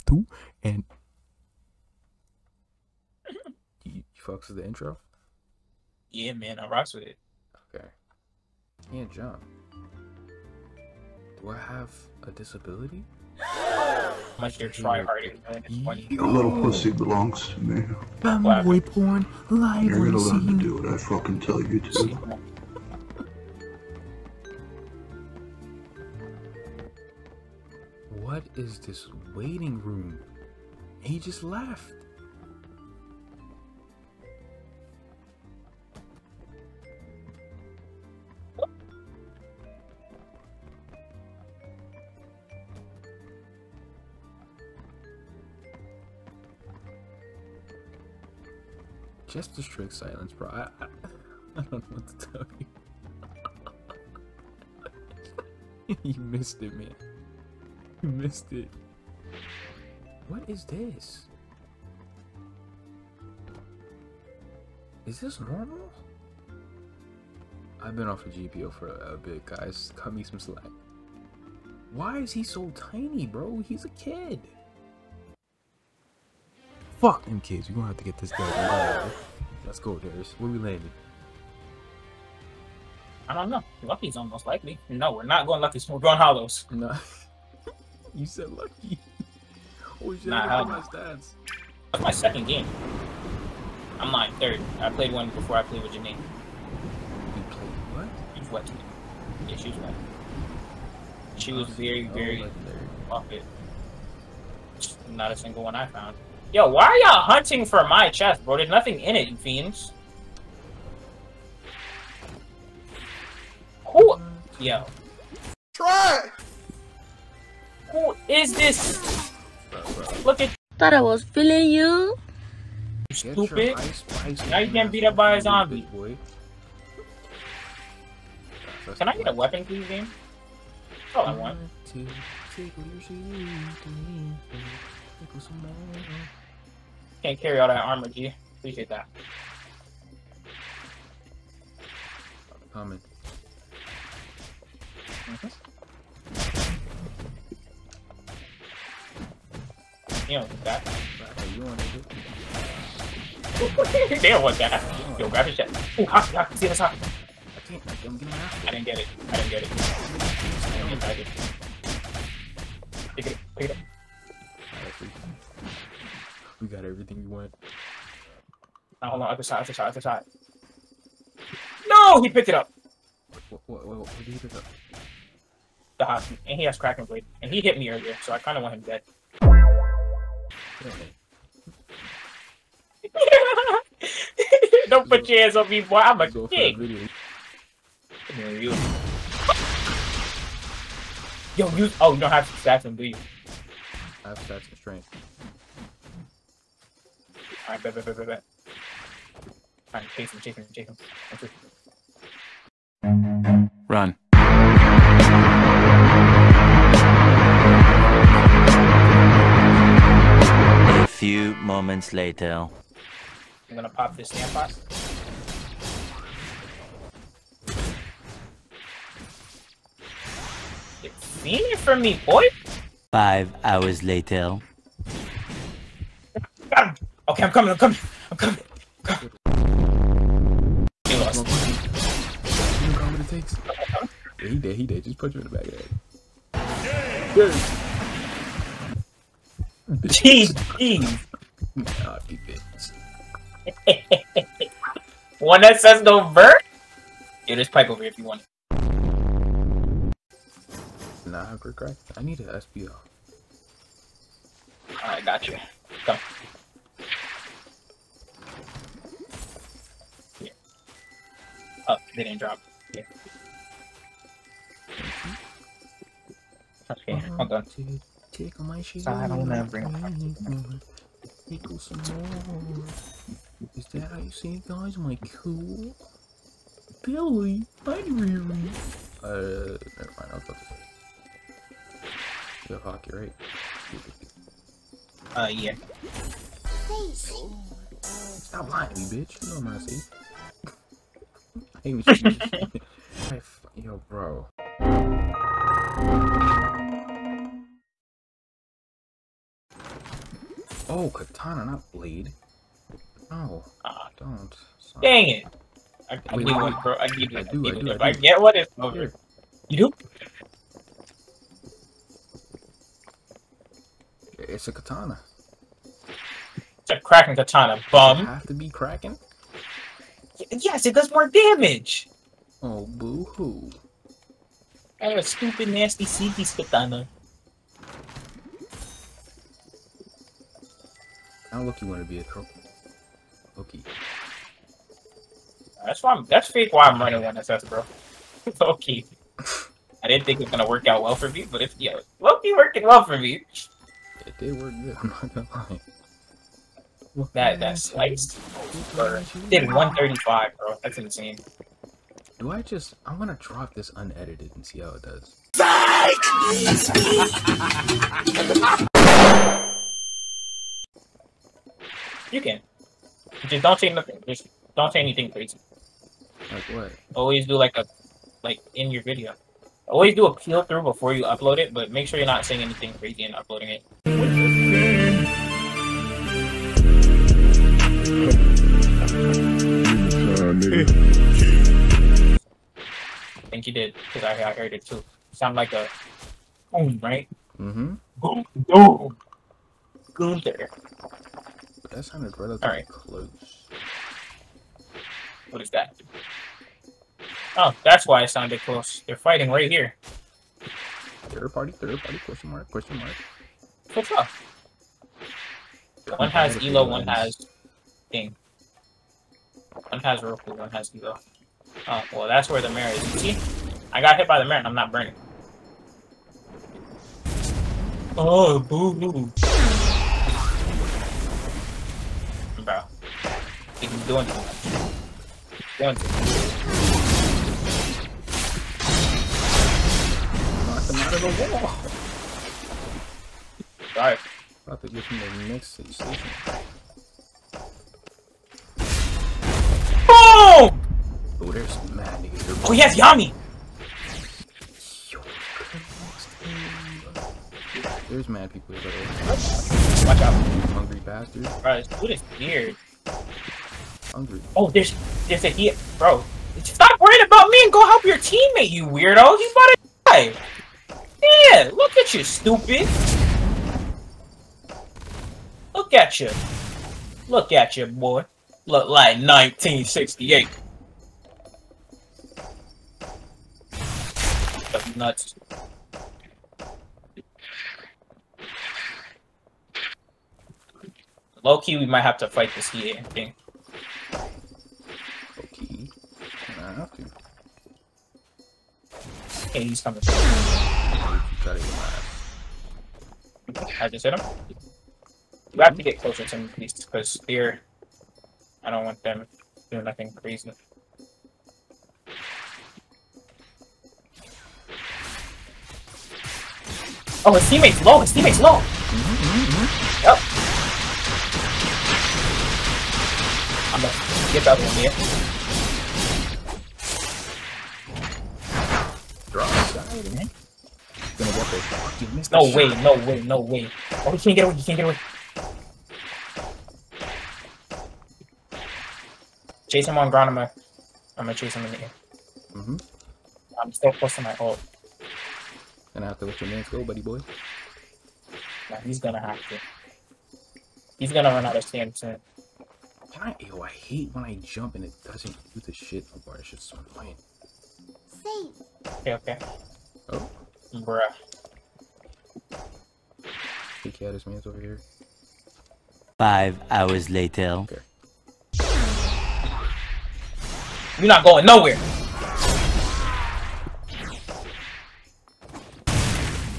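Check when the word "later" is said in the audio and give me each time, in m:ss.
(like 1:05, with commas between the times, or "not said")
3:32, 3:44, 9:17.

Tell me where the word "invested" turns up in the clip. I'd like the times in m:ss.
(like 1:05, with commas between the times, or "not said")
not said.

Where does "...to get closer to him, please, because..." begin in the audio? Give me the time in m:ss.
8:15.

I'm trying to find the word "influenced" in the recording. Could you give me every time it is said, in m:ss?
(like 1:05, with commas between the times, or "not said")
not said.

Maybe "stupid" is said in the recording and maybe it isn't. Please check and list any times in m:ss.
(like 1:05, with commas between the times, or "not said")
2:03, 5:25, 7:42.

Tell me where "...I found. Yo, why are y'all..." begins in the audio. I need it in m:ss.
1:45.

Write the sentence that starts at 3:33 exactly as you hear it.
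I'm gonna pop this stamp box.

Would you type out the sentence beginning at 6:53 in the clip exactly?
I got hit by the mirror, and I'm not burning.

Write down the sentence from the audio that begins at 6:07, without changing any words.
Always do like a, like in your video.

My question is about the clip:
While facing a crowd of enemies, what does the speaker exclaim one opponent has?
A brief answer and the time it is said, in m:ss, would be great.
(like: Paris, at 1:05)
Yami, at 7:22.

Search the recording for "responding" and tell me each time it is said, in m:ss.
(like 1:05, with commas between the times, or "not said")
not said.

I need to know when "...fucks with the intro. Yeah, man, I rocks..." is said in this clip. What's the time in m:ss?
0:04.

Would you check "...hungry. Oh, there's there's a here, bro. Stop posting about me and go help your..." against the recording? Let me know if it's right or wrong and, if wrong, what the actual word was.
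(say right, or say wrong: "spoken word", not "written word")
wrong: "worrying", not "posting".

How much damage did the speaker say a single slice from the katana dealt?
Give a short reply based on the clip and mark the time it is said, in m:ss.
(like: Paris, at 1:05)
135, at 5:49.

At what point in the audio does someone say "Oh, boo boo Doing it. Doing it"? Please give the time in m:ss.
6:58.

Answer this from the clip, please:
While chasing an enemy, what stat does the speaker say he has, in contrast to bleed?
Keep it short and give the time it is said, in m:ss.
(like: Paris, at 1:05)
strength, at 3:14.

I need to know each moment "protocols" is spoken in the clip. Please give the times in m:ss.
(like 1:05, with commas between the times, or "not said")
not said.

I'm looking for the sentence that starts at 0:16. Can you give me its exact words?
Your little pussy belongs to me.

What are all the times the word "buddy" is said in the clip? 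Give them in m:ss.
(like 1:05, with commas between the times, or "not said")
8:56.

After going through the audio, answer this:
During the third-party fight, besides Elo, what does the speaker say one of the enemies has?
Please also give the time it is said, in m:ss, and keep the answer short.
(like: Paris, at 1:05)
Roku, at 6:50.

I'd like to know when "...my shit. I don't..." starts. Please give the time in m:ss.
4:28.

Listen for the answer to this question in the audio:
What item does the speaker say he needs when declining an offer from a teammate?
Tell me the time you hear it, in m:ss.
4:12.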